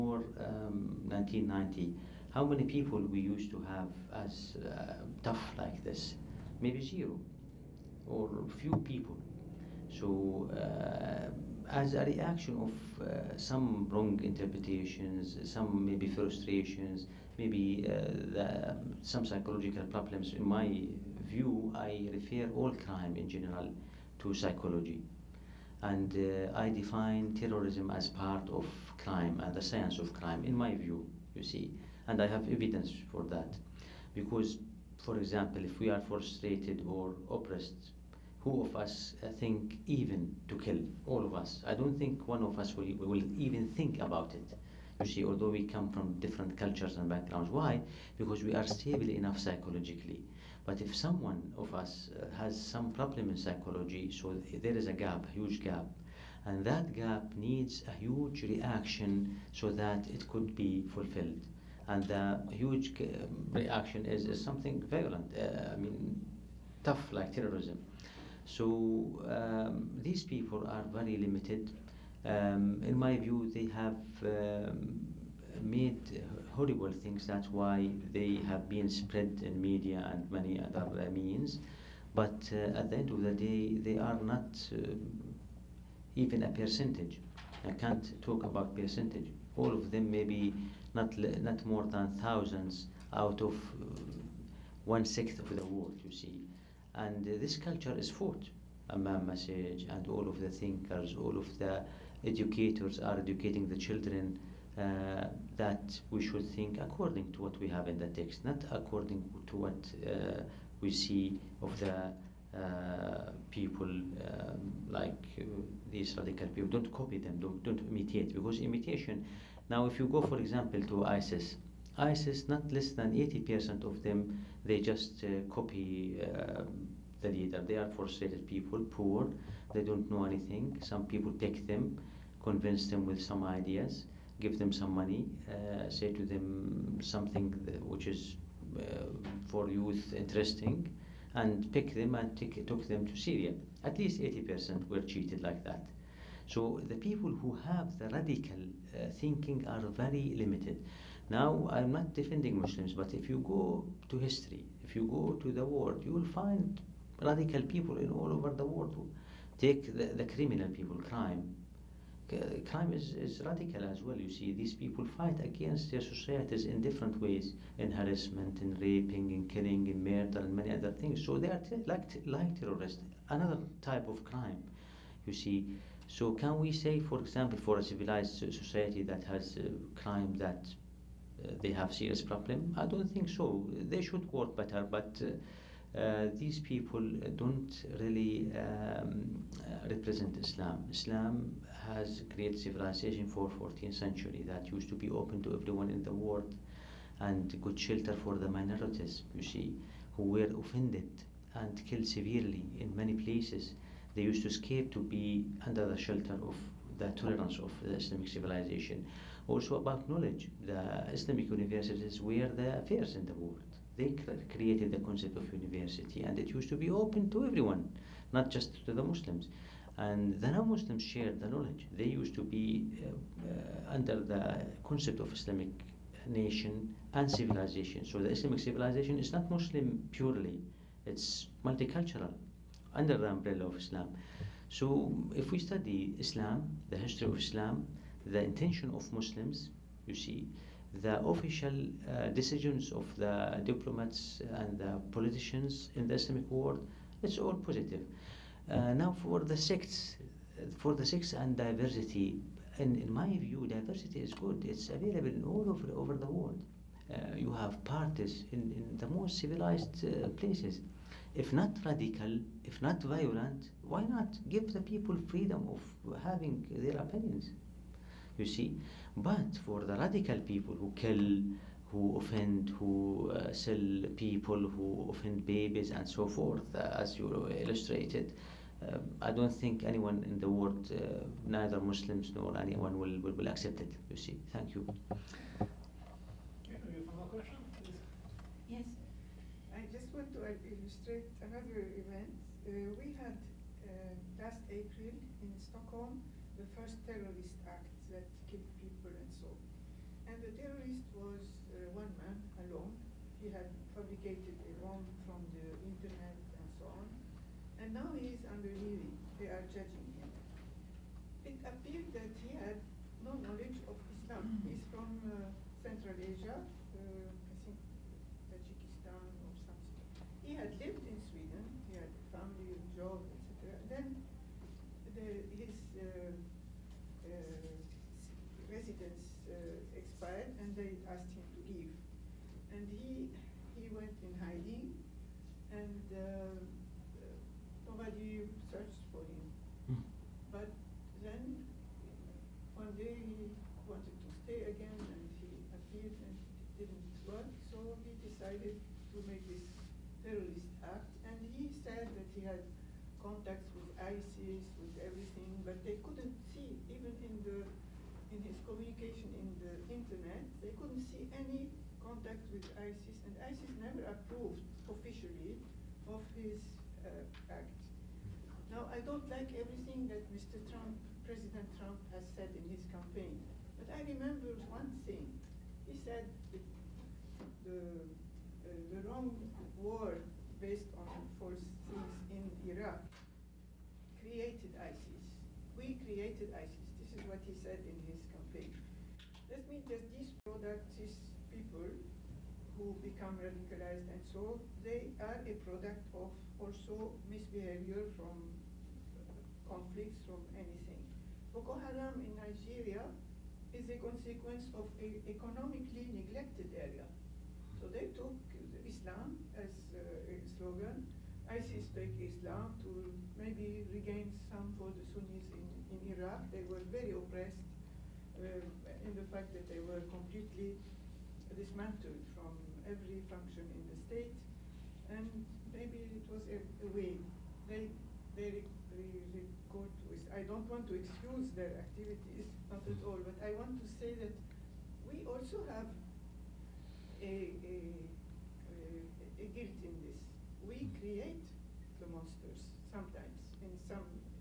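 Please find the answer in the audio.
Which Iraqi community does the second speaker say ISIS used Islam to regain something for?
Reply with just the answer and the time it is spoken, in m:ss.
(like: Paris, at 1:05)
Sunnis, at 6:55.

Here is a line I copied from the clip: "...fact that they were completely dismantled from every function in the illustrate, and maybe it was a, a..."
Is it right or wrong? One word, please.
wrong.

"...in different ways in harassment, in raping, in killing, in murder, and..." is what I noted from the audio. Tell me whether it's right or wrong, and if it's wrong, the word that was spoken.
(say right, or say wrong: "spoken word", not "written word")
right.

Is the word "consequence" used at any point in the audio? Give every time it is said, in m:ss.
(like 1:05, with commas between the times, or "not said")
6:44.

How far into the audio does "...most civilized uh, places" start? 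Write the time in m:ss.
4:19.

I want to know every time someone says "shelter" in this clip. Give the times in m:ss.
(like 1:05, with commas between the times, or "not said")
3:17, 3:25.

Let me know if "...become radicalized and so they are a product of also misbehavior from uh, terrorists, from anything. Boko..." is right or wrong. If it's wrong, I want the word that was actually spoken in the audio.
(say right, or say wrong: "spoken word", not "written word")
wrong: "conflicts", not "terrorists".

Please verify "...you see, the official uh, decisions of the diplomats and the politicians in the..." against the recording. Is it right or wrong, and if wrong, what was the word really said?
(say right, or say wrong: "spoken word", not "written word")
right.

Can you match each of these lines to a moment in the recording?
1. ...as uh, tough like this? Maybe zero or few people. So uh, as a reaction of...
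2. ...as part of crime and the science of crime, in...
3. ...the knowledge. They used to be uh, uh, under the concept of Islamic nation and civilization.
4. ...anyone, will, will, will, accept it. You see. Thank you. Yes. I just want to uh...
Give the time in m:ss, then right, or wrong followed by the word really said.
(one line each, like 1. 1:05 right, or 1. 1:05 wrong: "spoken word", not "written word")
1. 0:04 right
2. 0:27 right
3. 3:41 right
4. 4:42 right.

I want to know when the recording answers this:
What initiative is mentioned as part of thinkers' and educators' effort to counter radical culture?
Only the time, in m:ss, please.
1:38.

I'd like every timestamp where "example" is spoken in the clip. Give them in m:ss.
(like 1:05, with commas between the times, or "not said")
0:35, 2:00, 2:57.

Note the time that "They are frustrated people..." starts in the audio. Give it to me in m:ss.
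2:07.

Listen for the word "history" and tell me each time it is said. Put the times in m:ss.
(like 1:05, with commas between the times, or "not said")
2:34, 3:56.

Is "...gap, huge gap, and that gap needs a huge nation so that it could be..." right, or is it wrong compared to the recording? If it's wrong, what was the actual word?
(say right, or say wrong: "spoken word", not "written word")
wrong: "reaction", not "nation".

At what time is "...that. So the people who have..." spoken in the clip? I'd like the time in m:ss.
2:25.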